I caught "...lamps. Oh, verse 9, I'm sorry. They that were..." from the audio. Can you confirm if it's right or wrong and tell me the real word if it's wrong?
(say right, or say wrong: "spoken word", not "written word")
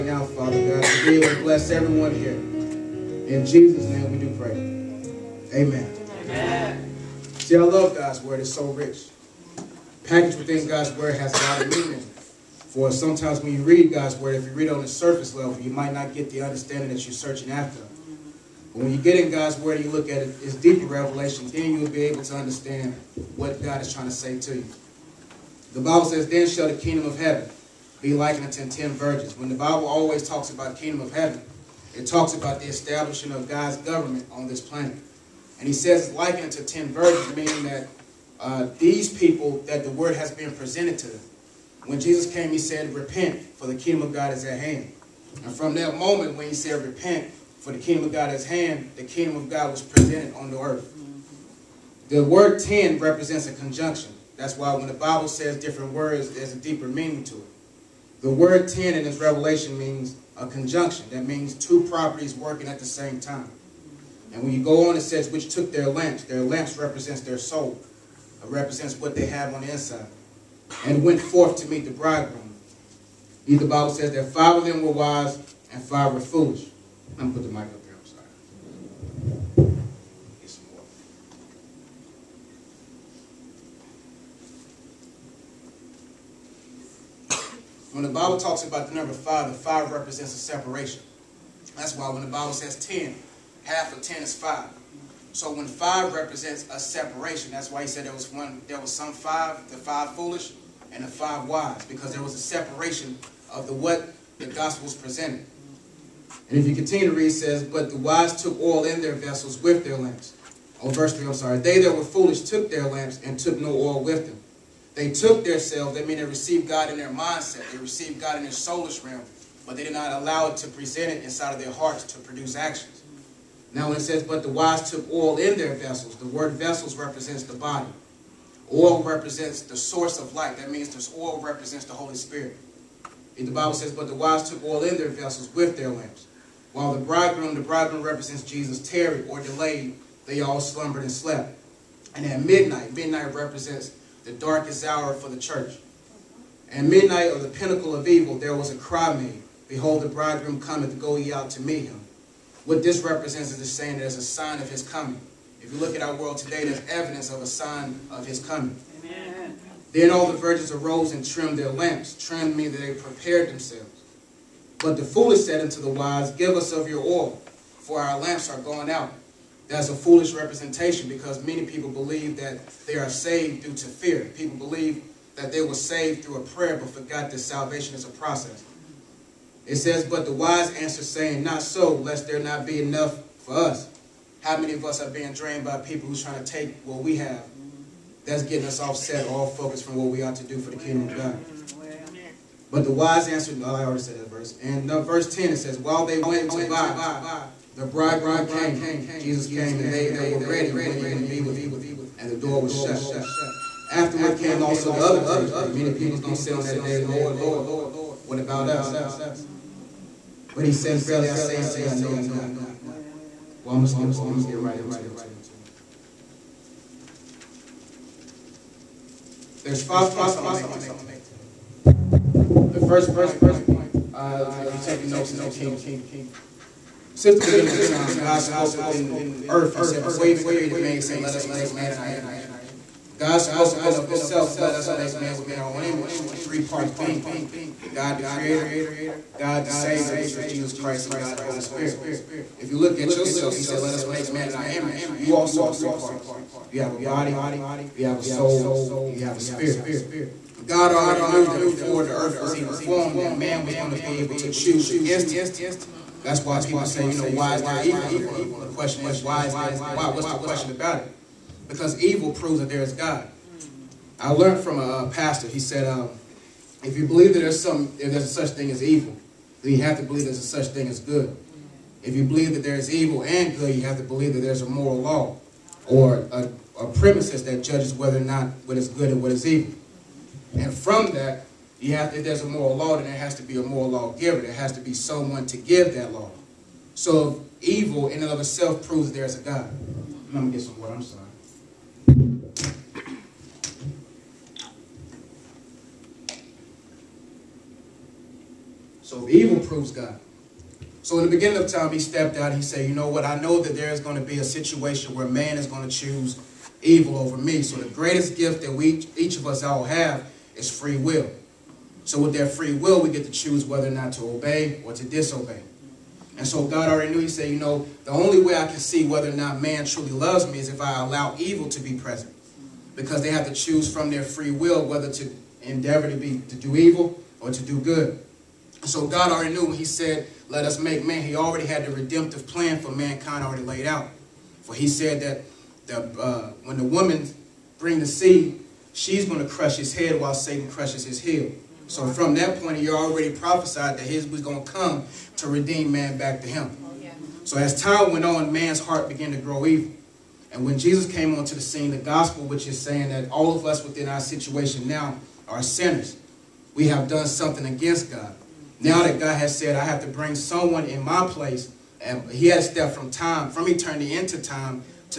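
wrong: "3", not "9".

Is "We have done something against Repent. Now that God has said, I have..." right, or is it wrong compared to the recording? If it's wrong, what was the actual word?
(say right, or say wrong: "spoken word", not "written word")
wrong: "God", not "Repent".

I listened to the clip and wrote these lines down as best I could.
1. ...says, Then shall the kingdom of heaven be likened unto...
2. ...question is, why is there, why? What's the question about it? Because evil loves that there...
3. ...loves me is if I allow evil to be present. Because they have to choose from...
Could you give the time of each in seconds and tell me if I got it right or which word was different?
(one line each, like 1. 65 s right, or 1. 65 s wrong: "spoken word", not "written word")
1. 26 s right
2. 258 s wrong: "proves", not "loves"
3. 320 s right.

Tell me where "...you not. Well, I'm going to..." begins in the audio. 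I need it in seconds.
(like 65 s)
212 s.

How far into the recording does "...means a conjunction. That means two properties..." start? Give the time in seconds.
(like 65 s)
59 s.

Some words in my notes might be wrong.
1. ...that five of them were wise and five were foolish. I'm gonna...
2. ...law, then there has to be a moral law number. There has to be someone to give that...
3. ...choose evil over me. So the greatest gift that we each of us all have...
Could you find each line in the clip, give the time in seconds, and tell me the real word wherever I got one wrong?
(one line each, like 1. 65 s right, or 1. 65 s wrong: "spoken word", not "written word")
1. 74 s right
2. 282 s wrong: "giver", not "number"
3. 305 s right.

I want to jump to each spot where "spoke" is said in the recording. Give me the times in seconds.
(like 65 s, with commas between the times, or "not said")
228 s, 233 s.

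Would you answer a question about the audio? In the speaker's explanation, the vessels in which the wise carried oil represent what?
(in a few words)
The body.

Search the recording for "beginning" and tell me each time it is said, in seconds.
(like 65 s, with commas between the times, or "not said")
227 s, 301 s.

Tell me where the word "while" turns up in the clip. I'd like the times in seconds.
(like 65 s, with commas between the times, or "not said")
136 s, 195 s, 340 s.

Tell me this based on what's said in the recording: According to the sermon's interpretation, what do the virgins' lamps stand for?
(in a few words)
Their soul.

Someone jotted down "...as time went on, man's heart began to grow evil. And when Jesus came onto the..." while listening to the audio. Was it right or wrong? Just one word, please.
right.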